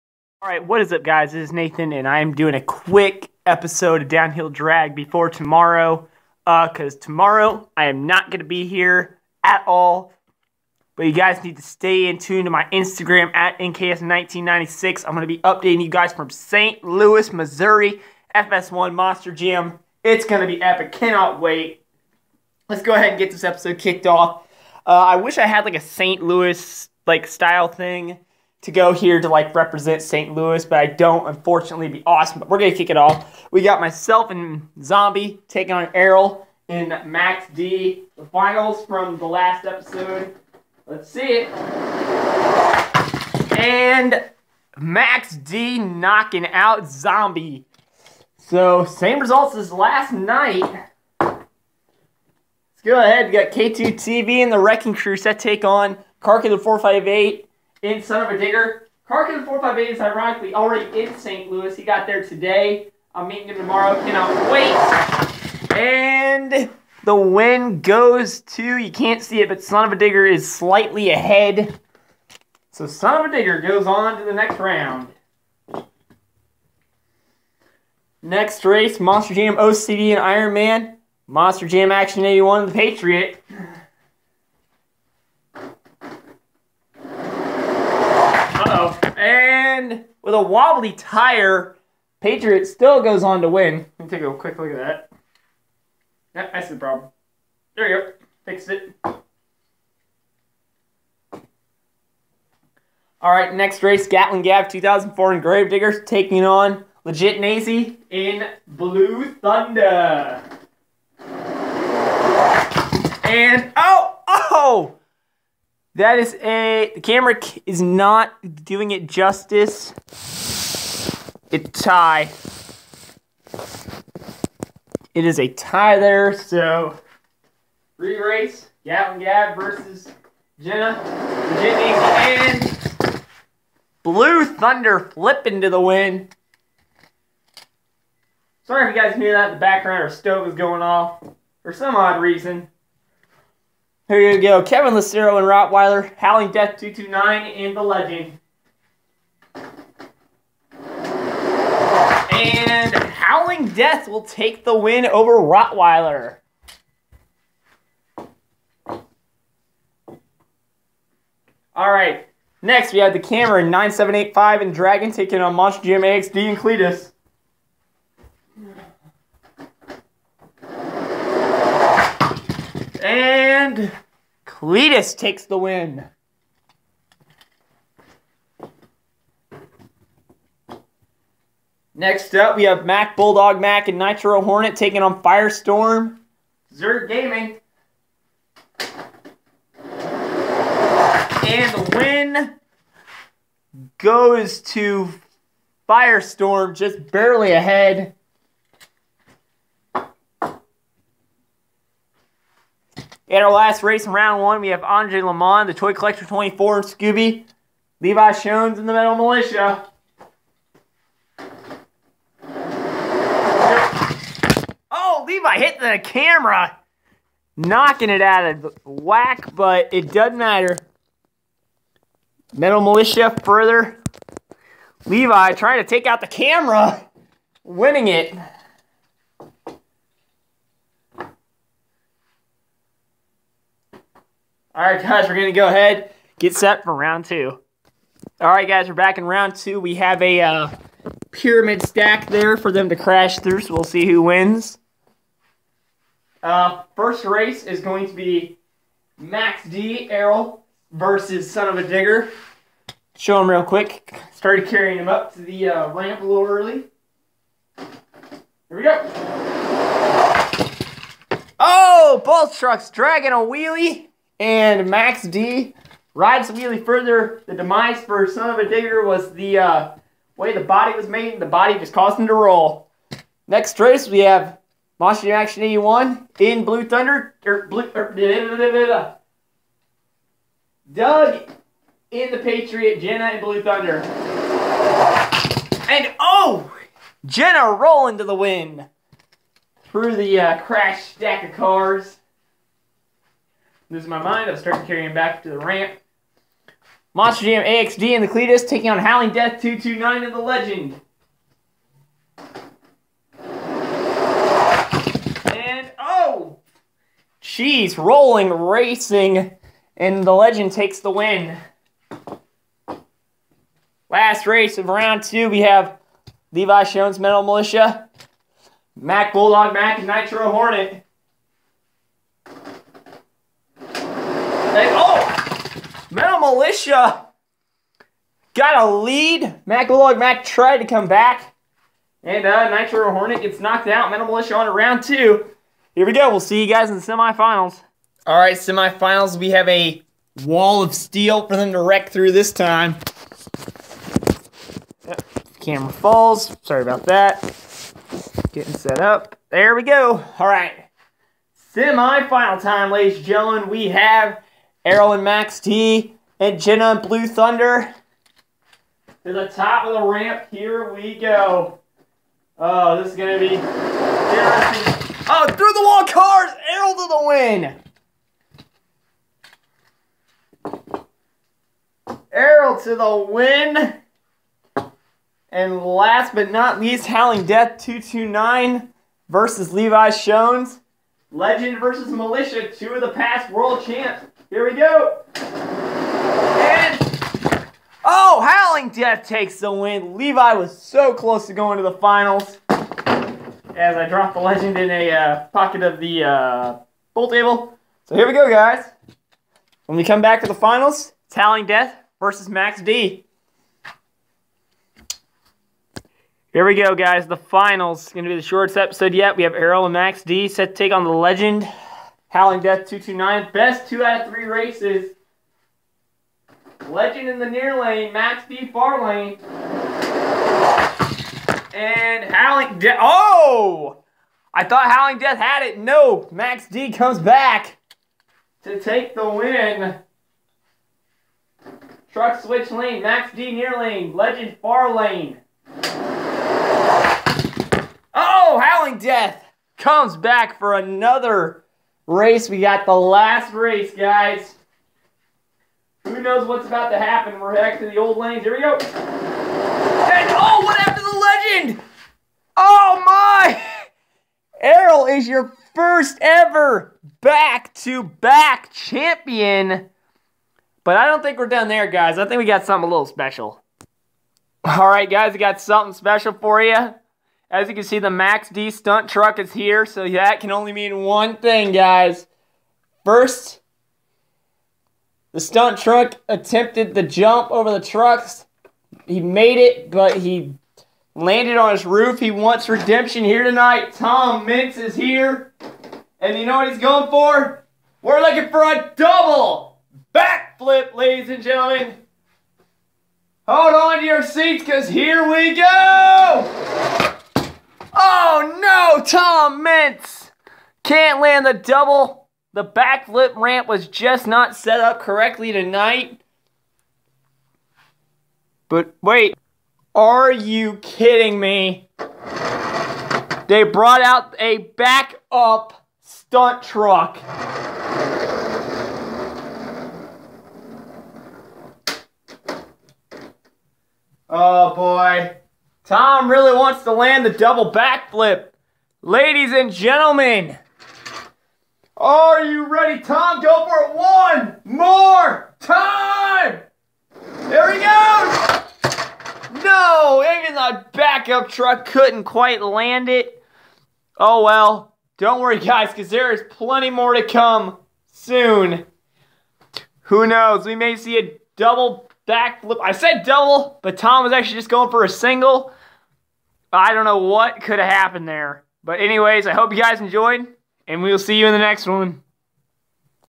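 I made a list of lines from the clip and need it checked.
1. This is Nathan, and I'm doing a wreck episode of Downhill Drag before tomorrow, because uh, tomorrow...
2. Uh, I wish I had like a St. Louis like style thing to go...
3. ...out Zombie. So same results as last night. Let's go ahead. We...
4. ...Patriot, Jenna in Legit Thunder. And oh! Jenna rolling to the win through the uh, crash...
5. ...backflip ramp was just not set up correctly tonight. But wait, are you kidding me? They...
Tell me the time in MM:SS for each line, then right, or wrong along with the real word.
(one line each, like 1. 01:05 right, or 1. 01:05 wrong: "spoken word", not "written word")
1. 00:01 wrong: "quick", not "wreck"
2. 00:24 right
3. 00:46 right
4. 04:42 wrong: "Blue", not "Legit"
5. 08:22 right.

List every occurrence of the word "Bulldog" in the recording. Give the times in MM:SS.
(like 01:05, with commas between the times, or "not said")
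03:03, 05:19.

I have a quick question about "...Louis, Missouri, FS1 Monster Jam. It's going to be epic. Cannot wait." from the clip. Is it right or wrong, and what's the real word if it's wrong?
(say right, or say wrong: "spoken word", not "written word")
right.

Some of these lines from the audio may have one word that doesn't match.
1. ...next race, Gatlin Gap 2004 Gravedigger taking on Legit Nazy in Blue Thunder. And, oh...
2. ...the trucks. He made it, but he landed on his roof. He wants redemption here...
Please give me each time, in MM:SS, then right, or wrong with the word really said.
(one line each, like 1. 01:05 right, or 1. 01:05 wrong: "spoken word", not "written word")
1. 01:43 right
2. 07:57 right.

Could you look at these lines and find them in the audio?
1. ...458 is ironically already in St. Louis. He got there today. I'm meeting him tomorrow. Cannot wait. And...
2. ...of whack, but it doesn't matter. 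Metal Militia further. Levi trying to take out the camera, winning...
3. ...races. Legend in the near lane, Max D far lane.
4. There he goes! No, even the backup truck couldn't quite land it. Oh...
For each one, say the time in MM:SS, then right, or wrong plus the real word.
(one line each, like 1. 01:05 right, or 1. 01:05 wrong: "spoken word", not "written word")
1. 00:59 right
2. 03:38 right
3. 06:54 right
4. 08:57 right.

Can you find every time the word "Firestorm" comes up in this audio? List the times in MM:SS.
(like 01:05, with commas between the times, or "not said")
03:05, 03:15.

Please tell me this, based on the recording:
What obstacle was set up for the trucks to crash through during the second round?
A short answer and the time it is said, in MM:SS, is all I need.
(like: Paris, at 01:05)
pyramid stack, at 04:01.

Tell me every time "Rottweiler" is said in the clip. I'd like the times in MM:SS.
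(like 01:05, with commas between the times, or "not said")
02:25, 02:35.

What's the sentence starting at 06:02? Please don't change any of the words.
Oh, this is going to be interesting.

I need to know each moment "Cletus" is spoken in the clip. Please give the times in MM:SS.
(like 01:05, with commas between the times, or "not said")
02:46, 02:54, 04:58.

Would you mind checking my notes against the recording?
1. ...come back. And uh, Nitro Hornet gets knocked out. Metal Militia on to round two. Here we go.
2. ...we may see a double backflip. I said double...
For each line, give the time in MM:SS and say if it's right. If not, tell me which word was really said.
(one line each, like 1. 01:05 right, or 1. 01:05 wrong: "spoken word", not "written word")
1. 05:30 right
2. 09:10 right.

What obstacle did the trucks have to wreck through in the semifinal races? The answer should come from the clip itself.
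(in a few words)
wall of steel.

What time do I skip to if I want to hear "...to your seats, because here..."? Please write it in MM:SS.
08:13.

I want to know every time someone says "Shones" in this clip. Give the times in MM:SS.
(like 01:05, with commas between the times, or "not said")
03:28, 05:16, 06:20.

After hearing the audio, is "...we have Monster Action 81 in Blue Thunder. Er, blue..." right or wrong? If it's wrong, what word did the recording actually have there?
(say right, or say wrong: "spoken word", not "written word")
right.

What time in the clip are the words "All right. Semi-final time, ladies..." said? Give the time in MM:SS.
05:50.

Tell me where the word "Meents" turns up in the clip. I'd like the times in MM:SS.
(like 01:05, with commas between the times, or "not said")
08:04, 08:19.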